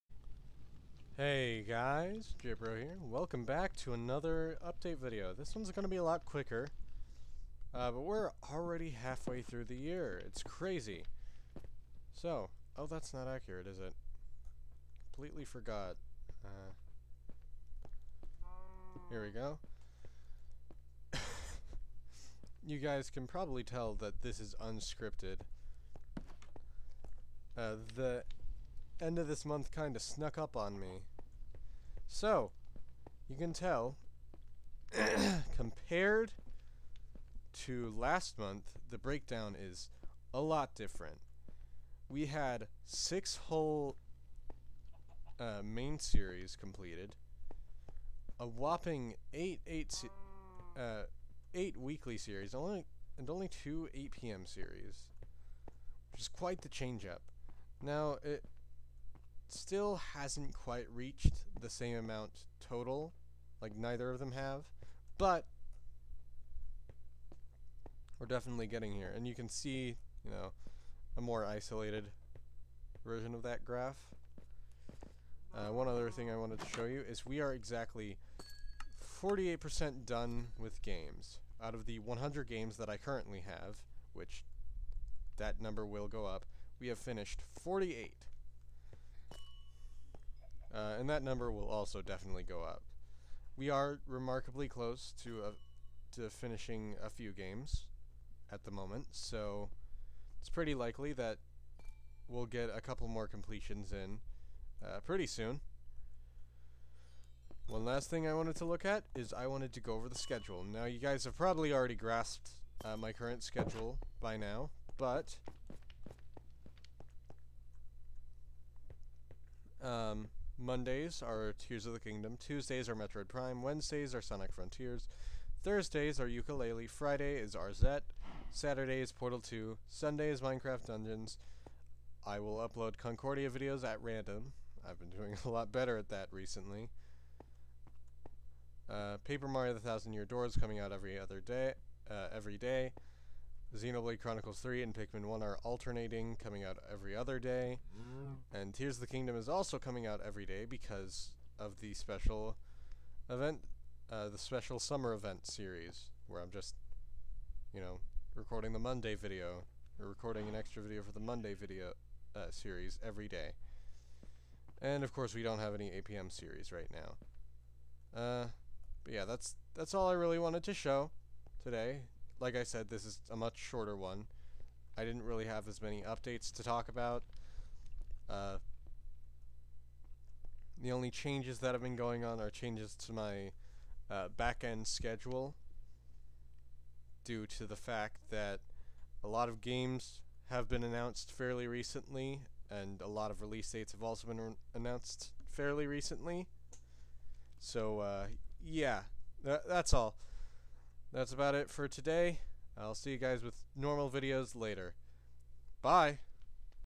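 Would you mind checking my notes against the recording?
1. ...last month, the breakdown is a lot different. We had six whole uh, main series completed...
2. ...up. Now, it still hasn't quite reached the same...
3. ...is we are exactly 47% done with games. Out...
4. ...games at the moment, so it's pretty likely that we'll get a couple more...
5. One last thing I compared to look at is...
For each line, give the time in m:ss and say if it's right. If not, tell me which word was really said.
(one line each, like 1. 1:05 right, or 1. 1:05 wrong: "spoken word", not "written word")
1. 0:37 right
2. 0:57 right
3. 1:17 wrong: "48", not "47"
4. 1:37 right
5. 1:47 wrong: "wanted", not "compared".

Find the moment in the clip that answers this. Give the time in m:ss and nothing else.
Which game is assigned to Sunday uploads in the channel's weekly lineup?
2:10.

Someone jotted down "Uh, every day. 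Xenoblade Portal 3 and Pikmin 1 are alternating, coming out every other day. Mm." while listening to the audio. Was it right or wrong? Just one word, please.
wrong.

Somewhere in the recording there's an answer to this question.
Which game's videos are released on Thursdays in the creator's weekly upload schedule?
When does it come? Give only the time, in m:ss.
2:06.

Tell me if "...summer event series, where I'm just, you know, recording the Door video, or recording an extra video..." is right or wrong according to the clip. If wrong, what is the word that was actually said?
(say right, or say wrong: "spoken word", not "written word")
wrong: "Monday", not "Door".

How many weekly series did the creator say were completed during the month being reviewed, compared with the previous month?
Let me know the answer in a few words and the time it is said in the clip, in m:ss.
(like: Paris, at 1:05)
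8, at 0:51.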